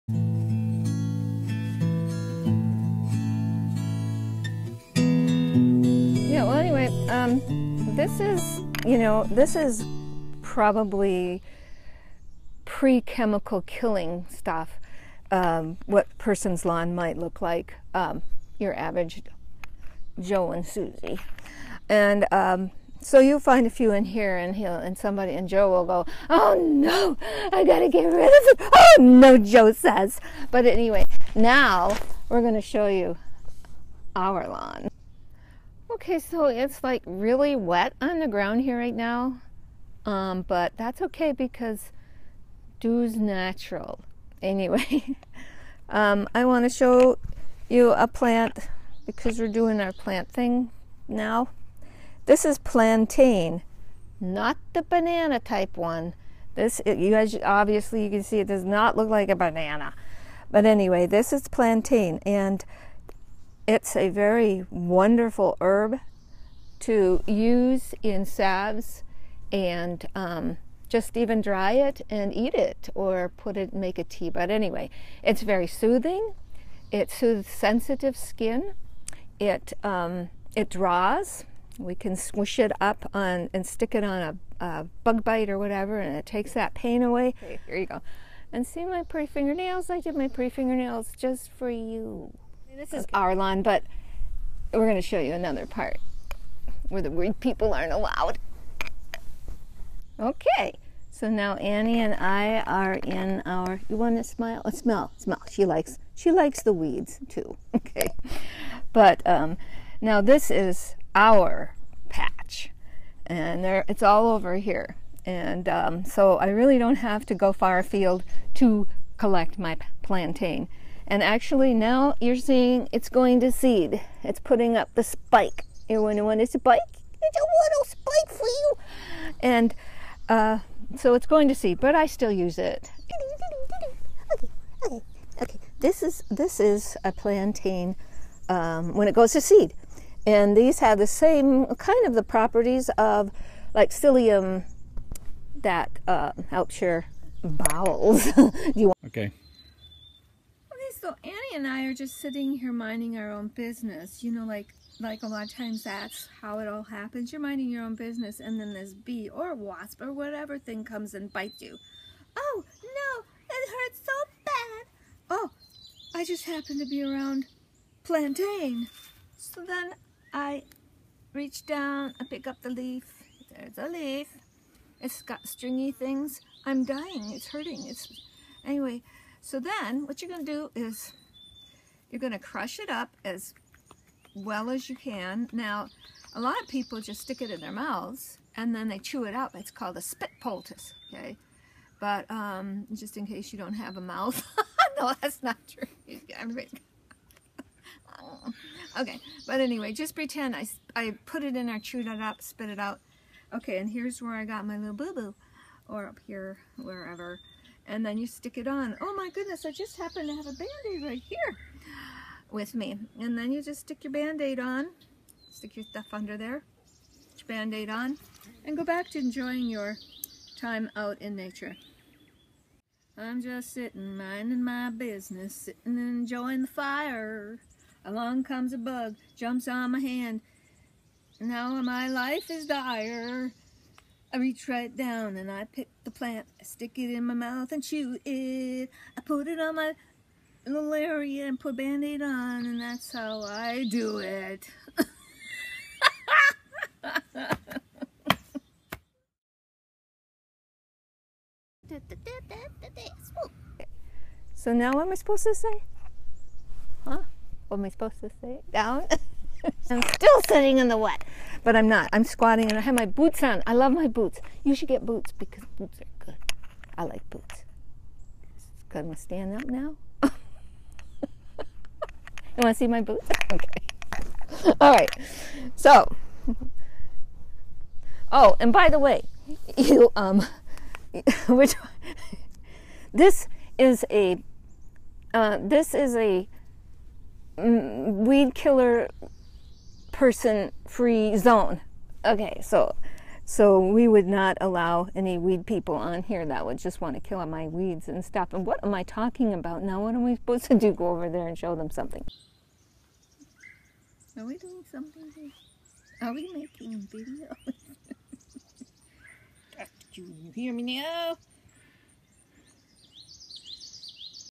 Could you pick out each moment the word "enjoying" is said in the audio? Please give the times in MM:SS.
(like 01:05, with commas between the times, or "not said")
03:39, 03:45.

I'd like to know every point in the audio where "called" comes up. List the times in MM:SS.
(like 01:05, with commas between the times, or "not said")
03:09.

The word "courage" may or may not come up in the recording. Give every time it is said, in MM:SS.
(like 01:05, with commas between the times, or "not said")
not said.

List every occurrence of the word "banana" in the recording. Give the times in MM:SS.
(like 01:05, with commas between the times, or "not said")
00:54, 00:59.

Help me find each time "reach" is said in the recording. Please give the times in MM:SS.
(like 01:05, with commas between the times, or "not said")
02:51, 03:54.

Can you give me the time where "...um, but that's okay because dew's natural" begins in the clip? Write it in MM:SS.
00:40.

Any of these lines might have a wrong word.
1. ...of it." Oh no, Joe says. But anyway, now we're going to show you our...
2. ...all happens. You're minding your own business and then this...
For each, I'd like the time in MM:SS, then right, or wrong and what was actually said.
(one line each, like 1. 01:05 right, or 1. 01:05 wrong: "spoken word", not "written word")
1. 00:28 right
2. 02:36 right.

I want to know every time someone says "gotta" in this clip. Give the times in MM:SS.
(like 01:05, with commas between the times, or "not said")
00:27.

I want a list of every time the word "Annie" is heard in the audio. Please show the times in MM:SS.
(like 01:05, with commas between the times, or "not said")
01:41, 02:31.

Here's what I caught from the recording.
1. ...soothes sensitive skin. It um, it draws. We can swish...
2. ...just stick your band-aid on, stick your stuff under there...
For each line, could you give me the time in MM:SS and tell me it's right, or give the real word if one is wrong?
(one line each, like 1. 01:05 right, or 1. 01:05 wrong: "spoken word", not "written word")
1. 01:17 right
2. 03:33 right.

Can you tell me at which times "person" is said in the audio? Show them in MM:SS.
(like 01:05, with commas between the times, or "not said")
00:16, 04:50.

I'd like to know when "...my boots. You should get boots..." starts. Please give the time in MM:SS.
04:23.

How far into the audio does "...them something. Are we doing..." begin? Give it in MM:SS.
05:01.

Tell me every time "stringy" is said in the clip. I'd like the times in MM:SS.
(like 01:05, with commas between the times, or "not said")
02:55.